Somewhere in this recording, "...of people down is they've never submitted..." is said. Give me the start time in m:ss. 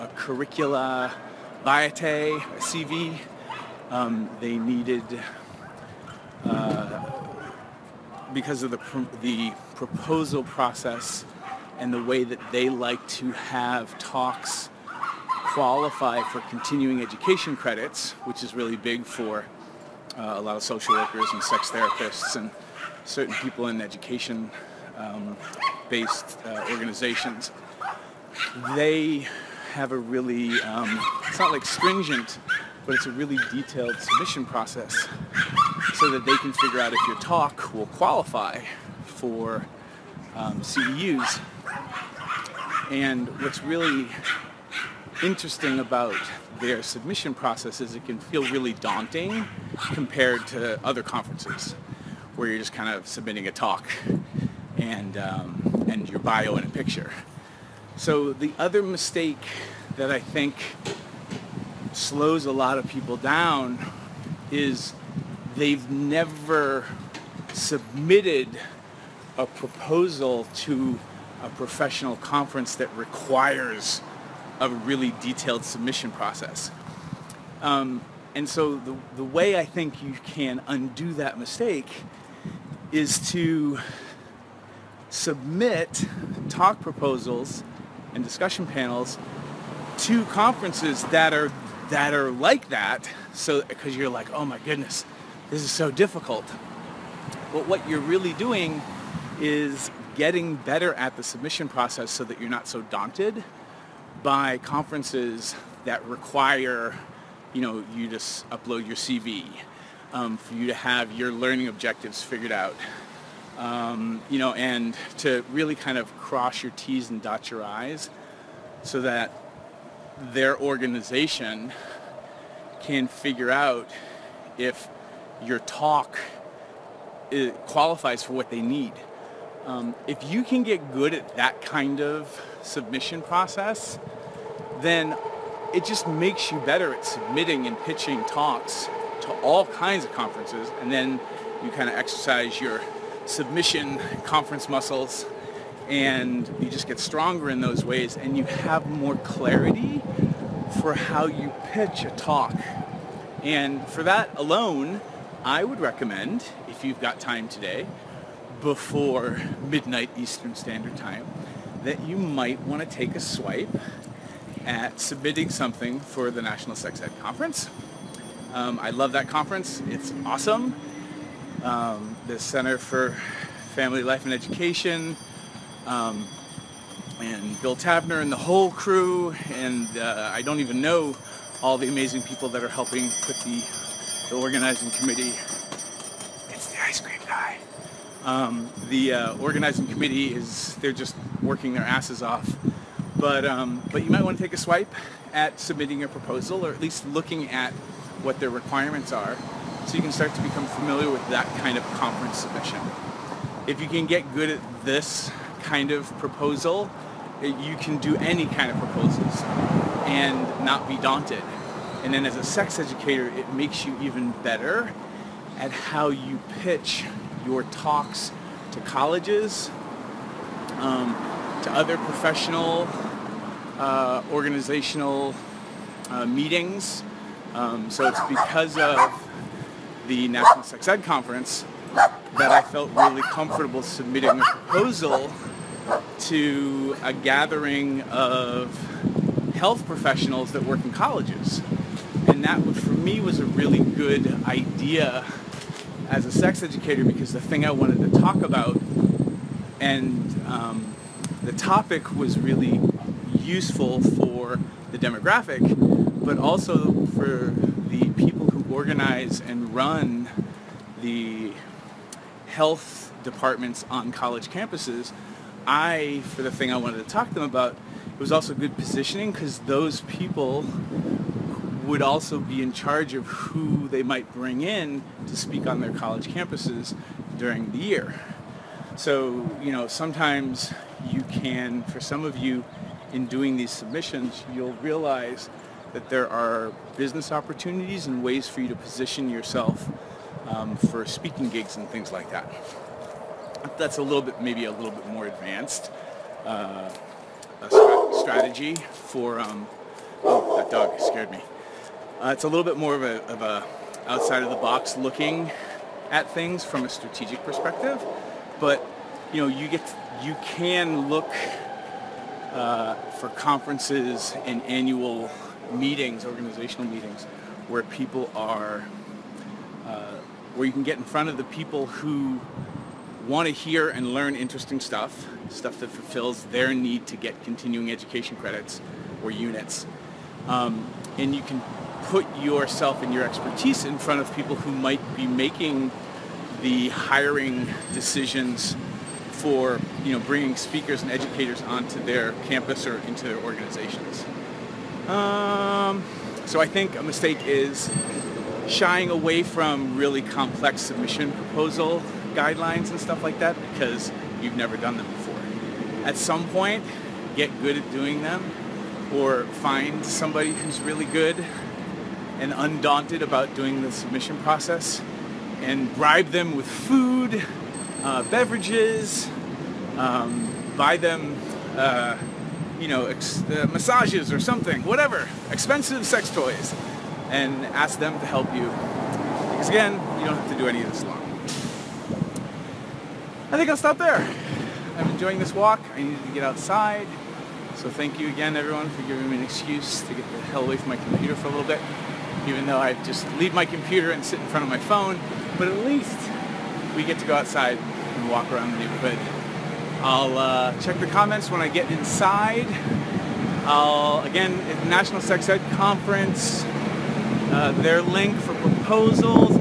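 1:02.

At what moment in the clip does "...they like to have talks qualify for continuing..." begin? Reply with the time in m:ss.
0:12.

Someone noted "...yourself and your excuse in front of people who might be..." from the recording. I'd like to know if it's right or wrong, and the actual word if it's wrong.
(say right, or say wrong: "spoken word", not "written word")
wrong: "expertise", not "excuse".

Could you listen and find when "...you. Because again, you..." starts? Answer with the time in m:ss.
6:18.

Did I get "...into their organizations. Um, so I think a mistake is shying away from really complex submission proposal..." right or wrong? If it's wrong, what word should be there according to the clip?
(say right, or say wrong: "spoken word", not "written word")
right.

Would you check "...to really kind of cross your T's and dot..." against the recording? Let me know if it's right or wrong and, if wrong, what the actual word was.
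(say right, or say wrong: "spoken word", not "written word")
right.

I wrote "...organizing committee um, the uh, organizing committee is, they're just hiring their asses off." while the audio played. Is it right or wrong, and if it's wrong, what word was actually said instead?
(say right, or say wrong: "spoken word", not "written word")
wrong: "working", not "hiring".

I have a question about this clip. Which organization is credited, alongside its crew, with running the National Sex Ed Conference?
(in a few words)
Center for Family Life and Education.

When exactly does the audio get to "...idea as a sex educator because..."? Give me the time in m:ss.
4:04.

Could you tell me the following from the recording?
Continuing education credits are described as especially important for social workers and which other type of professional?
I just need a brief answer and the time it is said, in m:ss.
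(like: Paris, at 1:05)
Sex therapists, at 0:21.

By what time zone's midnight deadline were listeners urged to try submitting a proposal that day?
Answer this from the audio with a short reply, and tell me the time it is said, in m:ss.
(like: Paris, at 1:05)
Eastern Standard Time, at 2:40.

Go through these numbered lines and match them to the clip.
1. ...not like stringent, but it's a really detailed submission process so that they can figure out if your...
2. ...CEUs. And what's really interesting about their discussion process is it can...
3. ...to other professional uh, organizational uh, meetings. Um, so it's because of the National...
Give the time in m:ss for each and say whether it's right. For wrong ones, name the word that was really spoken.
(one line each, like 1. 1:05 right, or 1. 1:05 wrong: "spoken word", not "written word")
1. 0:31 right
2. 0:40 wrong: "submission", not "discussion"
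3. 3:41 right.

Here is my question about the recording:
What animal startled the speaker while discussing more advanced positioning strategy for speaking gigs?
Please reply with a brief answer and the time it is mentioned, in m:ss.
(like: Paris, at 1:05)
Dog, at 5:00.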